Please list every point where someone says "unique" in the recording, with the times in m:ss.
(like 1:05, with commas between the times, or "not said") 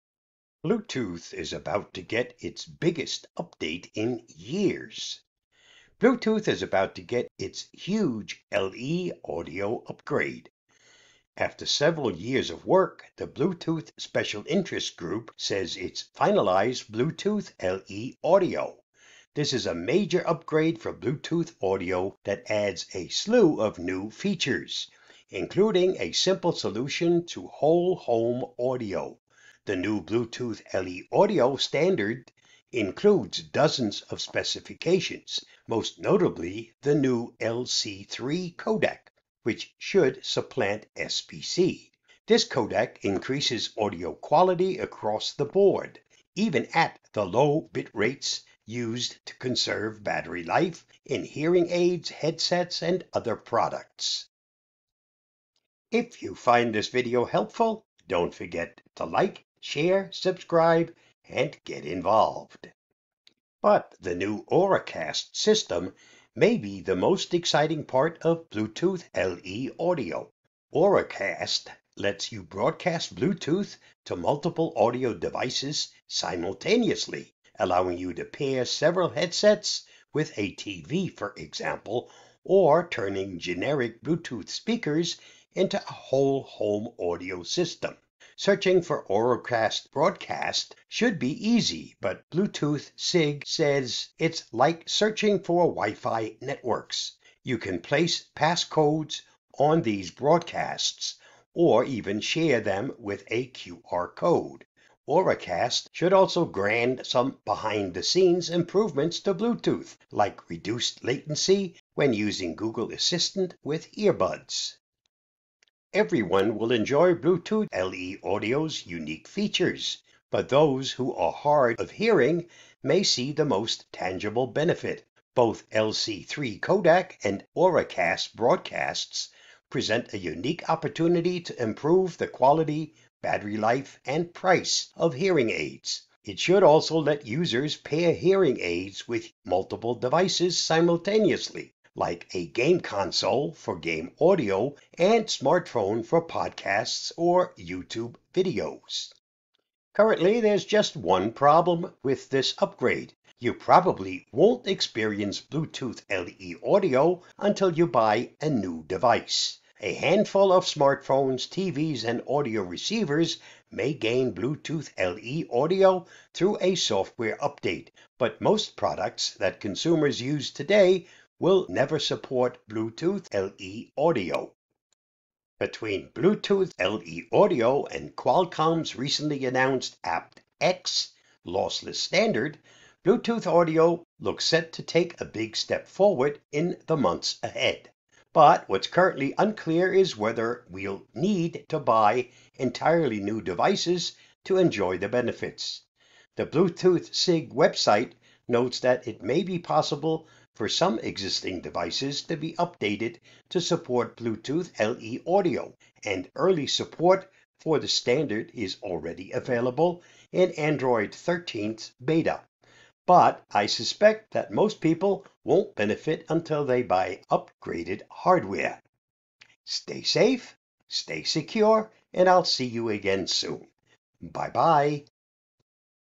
1:58, 2:10.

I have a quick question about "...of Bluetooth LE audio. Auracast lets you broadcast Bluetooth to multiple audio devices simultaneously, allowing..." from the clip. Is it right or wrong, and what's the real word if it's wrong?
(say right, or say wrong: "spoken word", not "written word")
right.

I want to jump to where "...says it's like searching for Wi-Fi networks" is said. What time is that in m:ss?
1:33.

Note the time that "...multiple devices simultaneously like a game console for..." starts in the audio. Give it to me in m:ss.
2:19.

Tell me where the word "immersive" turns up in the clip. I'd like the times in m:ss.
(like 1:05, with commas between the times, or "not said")
not said.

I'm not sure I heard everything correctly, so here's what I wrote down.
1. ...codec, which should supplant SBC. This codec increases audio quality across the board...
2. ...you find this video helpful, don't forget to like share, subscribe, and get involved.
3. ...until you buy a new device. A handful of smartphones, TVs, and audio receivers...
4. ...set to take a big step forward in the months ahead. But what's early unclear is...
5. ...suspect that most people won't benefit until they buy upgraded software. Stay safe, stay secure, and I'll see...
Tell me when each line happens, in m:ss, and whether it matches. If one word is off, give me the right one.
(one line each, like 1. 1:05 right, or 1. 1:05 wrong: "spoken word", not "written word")
1. 0:38 right
2. 0:56 right
3. 2:37 right
4. 3:04 wrong: "currently", not "early"
5. 3:33 wrong: "hardware", not "software".